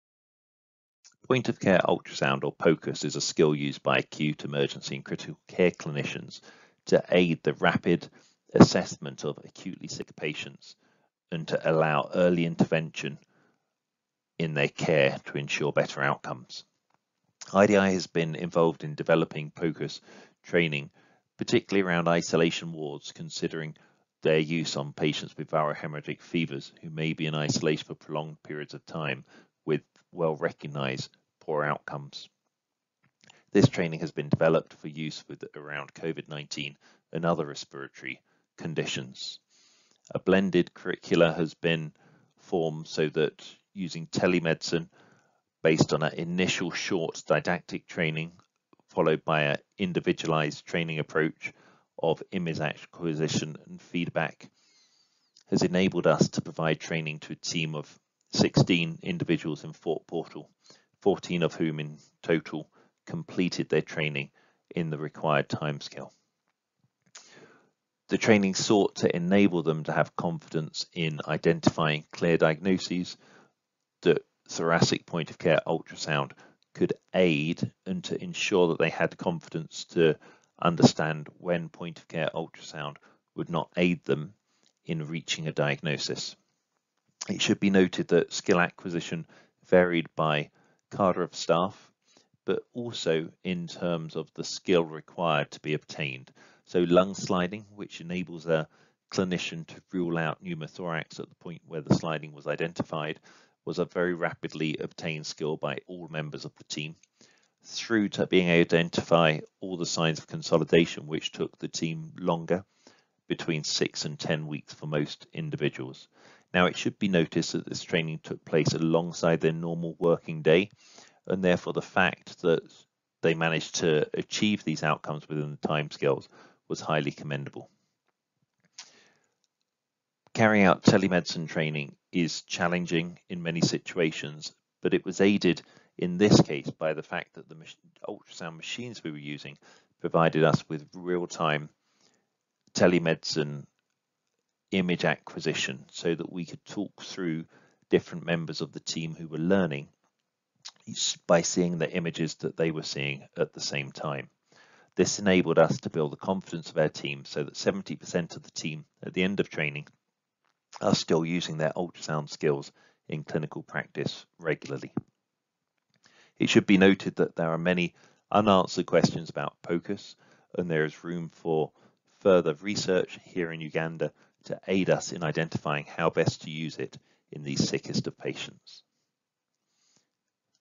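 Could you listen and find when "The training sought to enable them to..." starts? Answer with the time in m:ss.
1:08.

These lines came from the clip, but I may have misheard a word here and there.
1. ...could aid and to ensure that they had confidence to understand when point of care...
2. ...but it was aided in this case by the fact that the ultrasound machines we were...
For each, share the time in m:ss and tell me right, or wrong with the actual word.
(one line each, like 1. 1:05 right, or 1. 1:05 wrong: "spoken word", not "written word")
1. 1:16 right
2. 2:14 right.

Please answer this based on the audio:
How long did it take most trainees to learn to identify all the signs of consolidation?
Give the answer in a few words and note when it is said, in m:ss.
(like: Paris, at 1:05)
6 to 10 weeks, at 1:53.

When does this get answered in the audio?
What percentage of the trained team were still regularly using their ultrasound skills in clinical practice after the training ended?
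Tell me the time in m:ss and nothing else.
2:37.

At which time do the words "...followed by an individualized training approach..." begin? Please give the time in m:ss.
0:48.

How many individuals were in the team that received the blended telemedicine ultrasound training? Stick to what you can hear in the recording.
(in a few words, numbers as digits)
16.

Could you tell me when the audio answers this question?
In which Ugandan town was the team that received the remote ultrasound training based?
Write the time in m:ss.
0:59.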